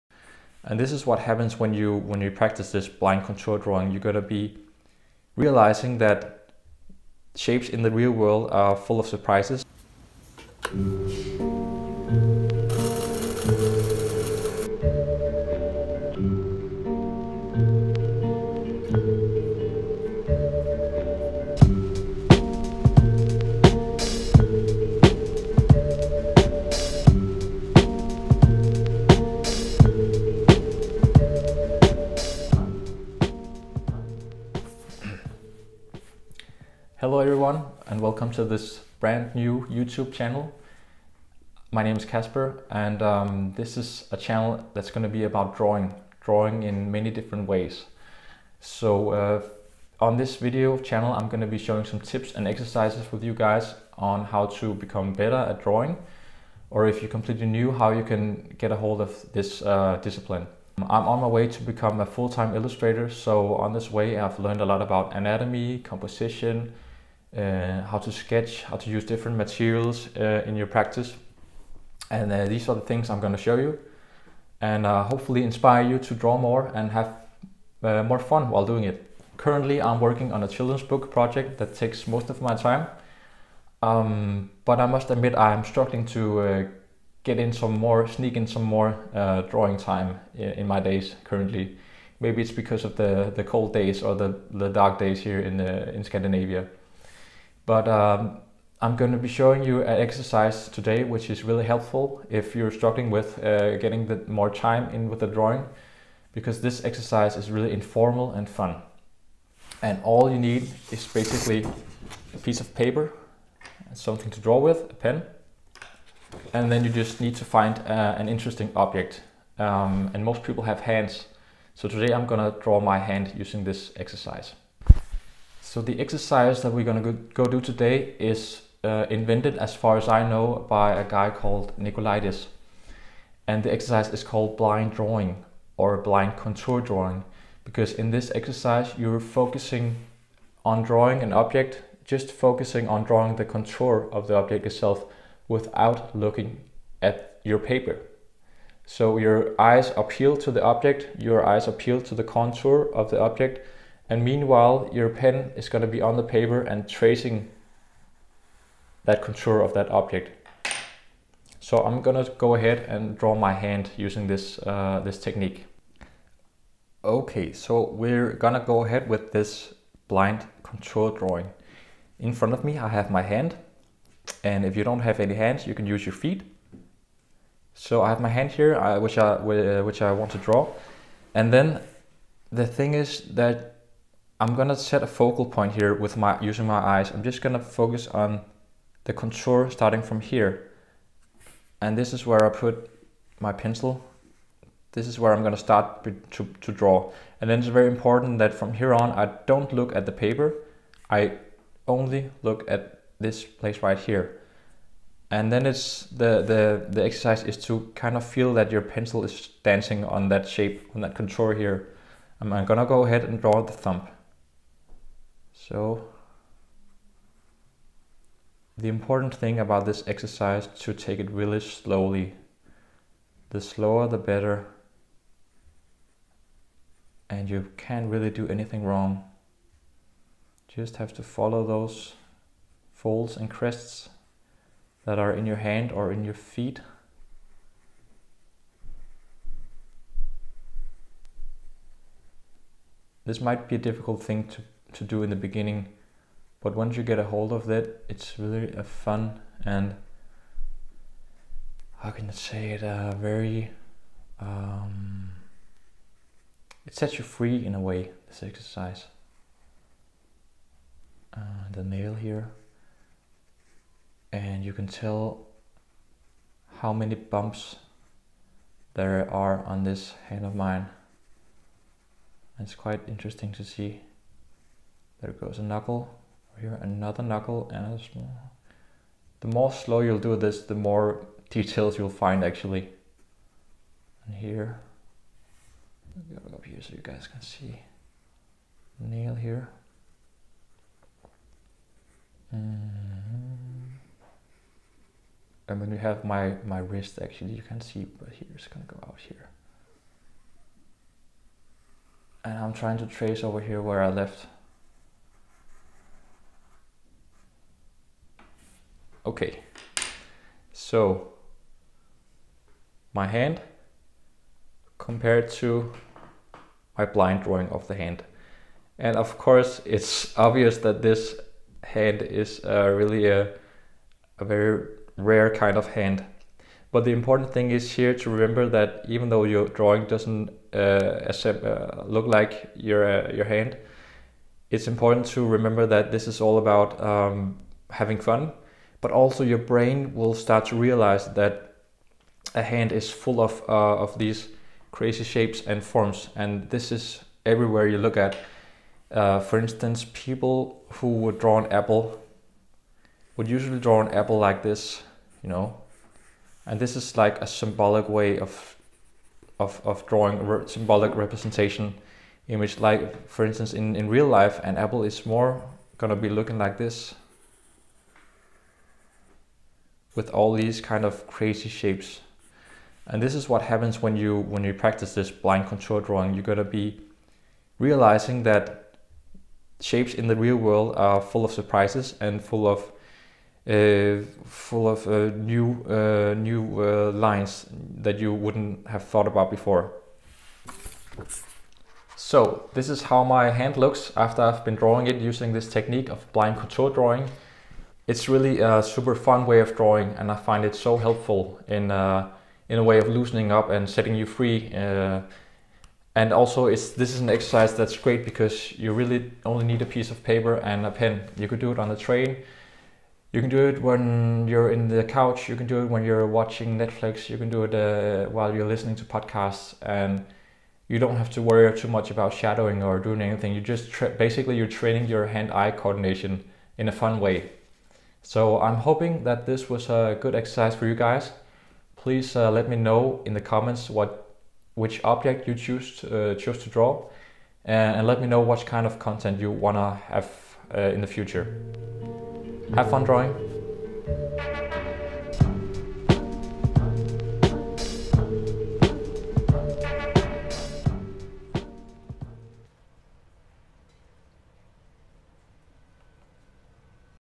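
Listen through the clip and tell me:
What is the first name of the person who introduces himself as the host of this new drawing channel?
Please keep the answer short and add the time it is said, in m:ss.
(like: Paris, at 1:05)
Kasper, at 0:42.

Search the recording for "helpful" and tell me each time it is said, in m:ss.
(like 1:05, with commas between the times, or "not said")
1:41, 6:40.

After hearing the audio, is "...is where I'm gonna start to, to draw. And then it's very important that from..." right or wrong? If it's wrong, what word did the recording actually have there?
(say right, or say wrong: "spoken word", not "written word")
right.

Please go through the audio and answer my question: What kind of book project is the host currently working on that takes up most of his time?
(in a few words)
children's book.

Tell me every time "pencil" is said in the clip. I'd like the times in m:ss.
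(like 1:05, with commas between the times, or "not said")
3:13, 3:28.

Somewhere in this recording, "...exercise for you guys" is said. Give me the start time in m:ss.
7:10.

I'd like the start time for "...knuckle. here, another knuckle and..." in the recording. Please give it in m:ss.
4:35.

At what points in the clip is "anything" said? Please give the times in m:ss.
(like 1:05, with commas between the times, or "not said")
3:48, 7:03.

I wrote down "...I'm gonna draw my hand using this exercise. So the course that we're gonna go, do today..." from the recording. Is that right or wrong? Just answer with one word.
wrong.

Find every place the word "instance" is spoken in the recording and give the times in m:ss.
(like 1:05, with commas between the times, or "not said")
5:49, 6:03.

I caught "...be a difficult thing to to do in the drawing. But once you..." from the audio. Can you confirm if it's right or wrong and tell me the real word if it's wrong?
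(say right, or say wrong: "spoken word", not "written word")
wrong: "beginning", not "drawing".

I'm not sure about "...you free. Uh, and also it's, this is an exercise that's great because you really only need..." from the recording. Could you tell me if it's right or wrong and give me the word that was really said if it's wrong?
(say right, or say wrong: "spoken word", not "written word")
right.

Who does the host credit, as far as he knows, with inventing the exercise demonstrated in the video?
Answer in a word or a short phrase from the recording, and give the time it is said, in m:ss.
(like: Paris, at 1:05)
Nicolaides, at 2:11.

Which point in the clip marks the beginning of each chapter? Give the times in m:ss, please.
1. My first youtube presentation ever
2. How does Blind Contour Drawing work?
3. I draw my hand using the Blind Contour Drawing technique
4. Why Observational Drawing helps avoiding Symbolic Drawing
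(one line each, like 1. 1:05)
1. 0:34
2. 2:05
3. 2:46
4. 5:51.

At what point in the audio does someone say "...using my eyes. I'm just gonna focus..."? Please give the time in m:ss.
3:06.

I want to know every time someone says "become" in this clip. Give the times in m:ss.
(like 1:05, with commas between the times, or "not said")
0:54, 1:01.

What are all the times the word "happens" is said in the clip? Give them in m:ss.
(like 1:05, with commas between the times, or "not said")
0:01, 6:13.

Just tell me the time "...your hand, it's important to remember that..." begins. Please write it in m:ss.
5:33.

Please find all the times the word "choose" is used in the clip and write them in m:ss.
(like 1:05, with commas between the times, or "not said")
7:15.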